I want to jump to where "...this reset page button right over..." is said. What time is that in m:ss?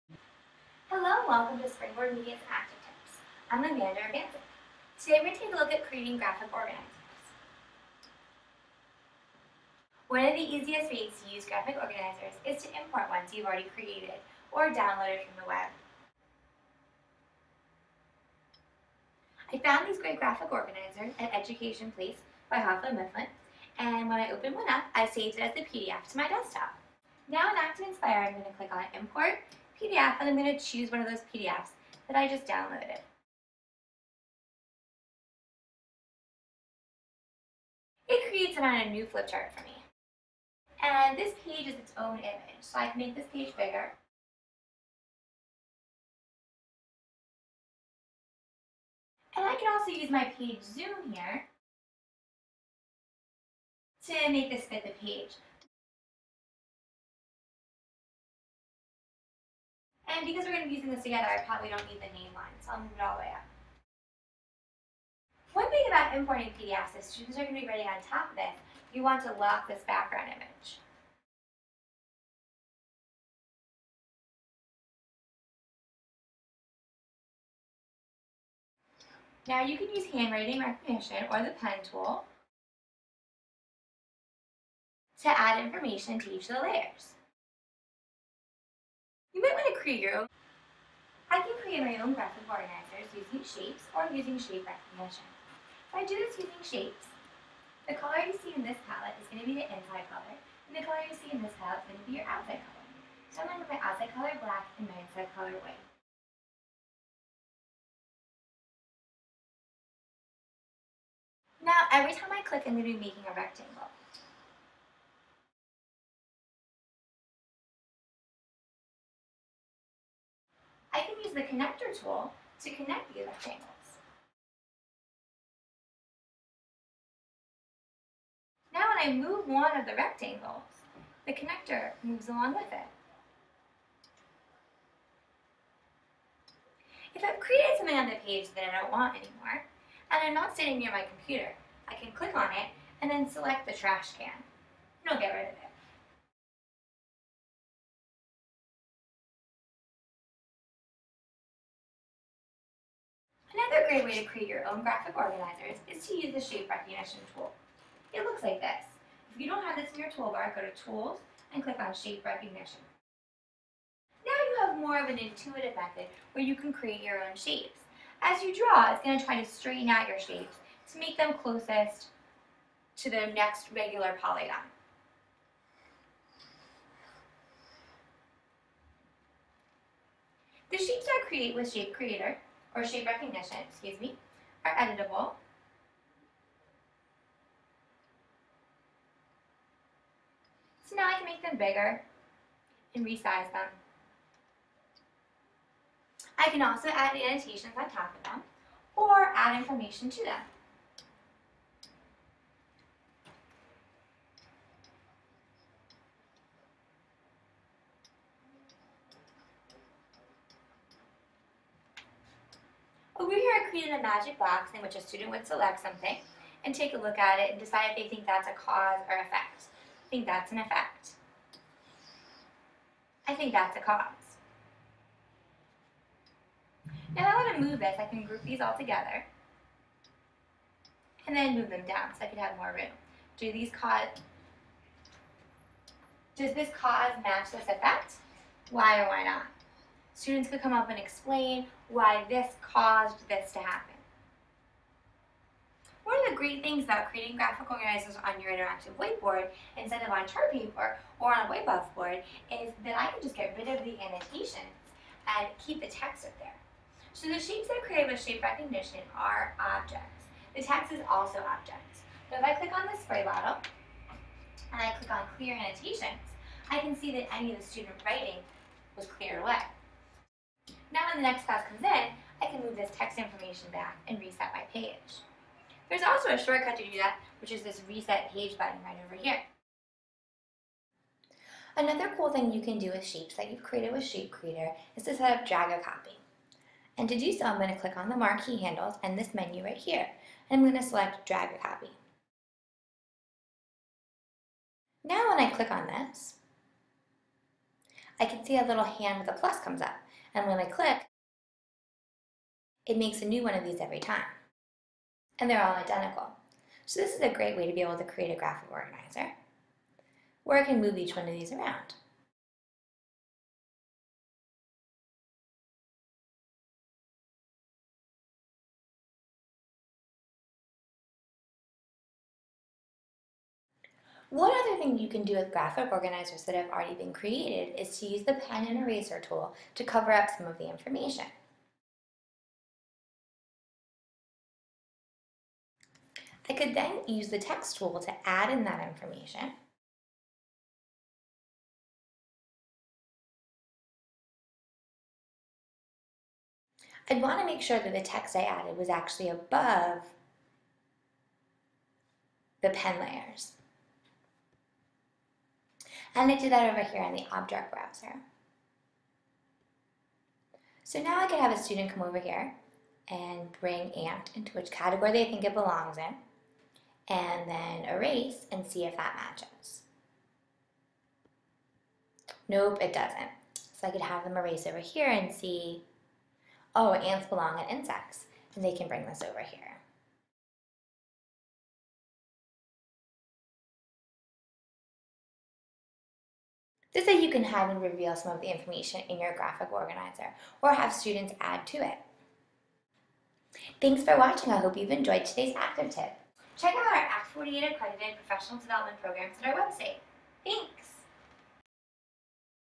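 4:37.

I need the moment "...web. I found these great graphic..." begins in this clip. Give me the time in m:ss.
0:15.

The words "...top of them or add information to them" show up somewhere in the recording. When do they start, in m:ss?
3:17.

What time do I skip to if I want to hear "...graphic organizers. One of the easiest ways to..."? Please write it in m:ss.
0:06.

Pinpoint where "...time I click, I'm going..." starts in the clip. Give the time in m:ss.
1:52.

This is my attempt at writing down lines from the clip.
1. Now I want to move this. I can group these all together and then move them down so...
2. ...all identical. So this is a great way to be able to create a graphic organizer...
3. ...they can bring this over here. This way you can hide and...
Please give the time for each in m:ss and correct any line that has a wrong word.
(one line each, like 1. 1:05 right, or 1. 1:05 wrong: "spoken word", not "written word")
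1. 3:47 right
2. 5:05 right
3. 6:18 right.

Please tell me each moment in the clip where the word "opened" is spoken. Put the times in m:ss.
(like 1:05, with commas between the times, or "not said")
0:24.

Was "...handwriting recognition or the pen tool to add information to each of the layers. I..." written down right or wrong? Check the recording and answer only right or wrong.
right.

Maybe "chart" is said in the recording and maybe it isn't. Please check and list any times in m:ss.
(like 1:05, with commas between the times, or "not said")
0:39, 4:10.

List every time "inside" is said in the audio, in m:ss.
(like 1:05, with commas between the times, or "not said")
1:39, 1:45.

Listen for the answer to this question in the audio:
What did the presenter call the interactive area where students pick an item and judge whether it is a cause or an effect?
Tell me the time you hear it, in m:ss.
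3:34.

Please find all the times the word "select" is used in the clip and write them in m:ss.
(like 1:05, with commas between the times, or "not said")
2:23, 3:35, 4:50.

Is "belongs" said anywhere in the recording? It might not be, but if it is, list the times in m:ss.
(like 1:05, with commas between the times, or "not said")
6:05, 6:17.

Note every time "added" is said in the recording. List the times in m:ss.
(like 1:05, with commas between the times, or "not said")
5:48.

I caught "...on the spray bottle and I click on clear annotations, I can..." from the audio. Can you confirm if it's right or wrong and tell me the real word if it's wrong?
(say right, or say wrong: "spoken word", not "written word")
right.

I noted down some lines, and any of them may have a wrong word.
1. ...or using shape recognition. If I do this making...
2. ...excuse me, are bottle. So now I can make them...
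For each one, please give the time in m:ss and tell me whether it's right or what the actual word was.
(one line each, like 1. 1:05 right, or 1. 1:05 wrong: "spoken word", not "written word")
1. 1:33 wrong: "using", not "making"
2. 3:03 wrong: "editable", not "bottle".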